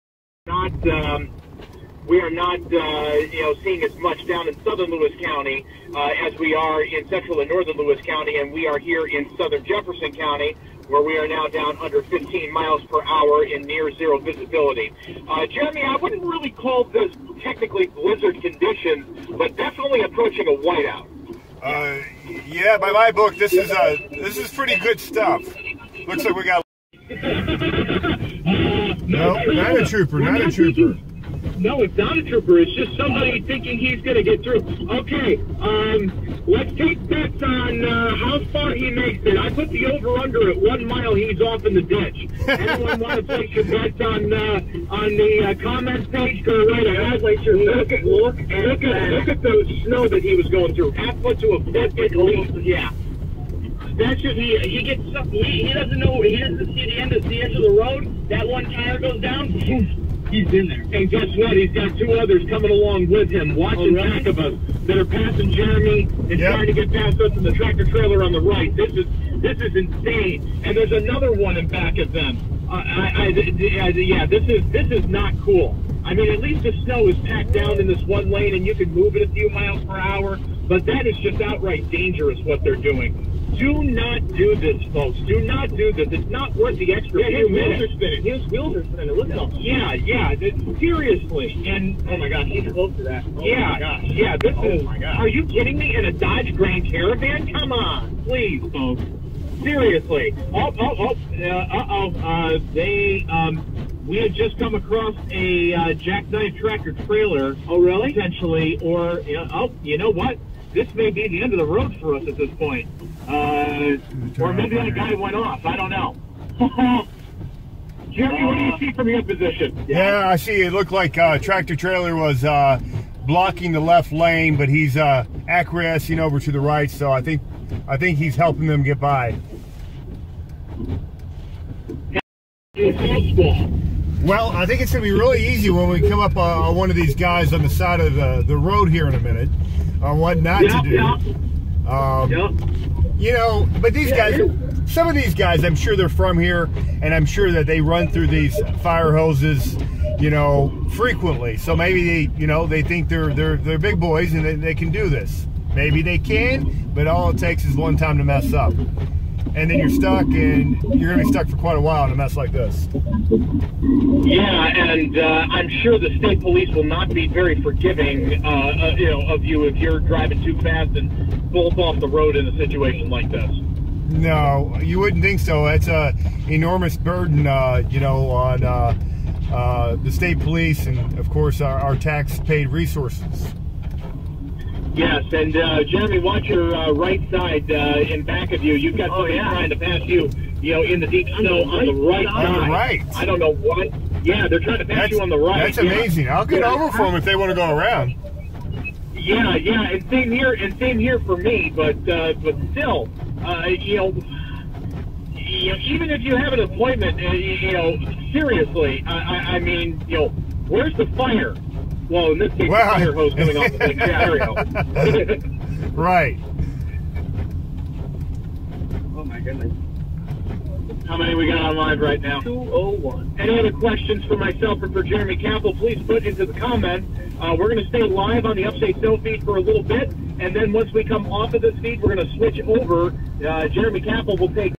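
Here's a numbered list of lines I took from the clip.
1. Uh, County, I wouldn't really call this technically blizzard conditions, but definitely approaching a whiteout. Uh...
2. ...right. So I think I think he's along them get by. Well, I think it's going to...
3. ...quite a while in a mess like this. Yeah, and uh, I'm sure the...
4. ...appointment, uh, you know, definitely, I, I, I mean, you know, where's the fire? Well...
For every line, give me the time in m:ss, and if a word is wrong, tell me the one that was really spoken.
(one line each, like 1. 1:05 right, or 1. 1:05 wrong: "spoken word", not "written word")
1. 0:15 wrong: "Jeremy", not "County"
2. 2:06 wrong: "helping", not "along"
3. 2:41 right
4. 3:26 wrong: "seriously", not "definitely".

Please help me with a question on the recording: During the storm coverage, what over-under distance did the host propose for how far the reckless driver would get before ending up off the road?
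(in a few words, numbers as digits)
1 mile.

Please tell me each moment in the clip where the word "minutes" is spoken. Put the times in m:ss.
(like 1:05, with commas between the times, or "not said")
1:27, 2:19.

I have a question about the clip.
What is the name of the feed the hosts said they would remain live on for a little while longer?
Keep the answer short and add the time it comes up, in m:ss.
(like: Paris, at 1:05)
Upstate Snow, at 3:48.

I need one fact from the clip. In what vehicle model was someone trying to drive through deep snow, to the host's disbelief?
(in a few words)
Dodge Grand Caravan.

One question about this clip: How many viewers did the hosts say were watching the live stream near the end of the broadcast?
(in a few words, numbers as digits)
201.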